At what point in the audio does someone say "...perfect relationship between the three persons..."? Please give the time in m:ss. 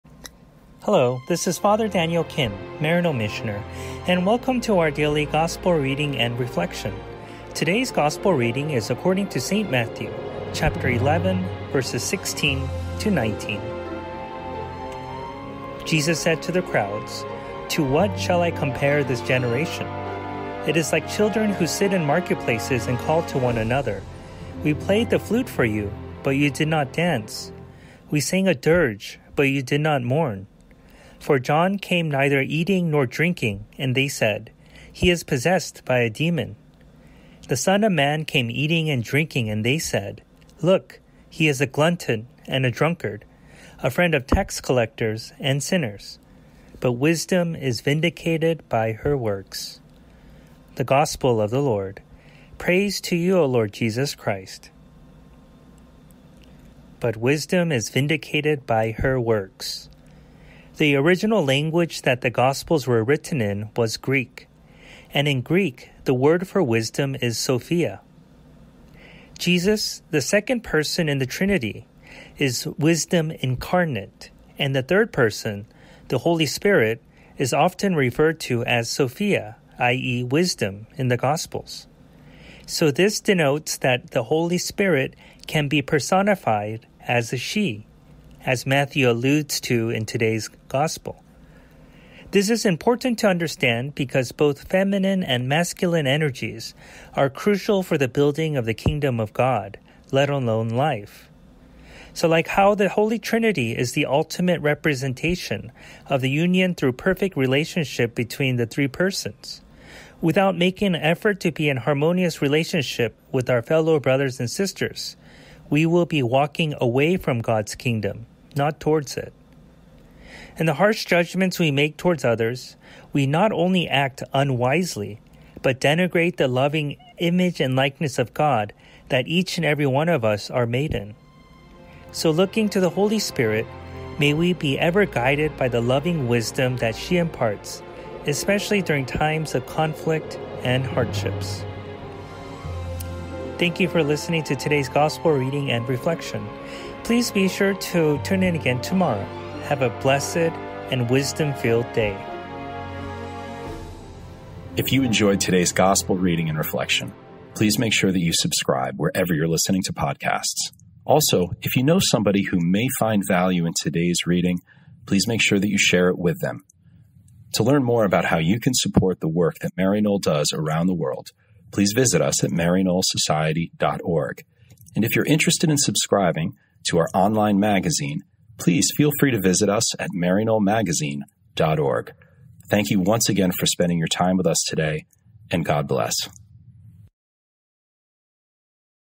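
1:46.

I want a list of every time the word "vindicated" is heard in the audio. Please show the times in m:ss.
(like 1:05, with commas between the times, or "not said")
0:47, 0:57.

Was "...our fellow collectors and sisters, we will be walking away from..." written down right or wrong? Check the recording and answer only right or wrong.
wrong.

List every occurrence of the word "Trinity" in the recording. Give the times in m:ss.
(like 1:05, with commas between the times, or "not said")
1:11, 1:43.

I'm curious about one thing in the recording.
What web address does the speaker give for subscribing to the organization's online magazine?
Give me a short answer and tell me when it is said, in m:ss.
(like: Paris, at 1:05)
maryknollmagazine.org, at 3:00.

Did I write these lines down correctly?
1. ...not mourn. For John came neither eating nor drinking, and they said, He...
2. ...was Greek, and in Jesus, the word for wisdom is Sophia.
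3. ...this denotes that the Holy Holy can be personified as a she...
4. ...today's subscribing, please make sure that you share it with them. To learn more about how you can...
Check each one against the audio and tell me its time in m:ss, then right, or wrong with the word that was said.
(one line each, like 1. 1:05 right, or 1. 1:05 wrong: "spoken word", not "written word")
1. 0:29 right
2. 1:03 wrong: "Greek", not "Jesus"
3. 1:22 wrong: "Spirit", not "Holy"
4. 2:43 wrong: "reading", not "subscribing".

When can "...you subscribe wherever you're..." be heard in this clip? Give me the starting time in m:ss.
2:38.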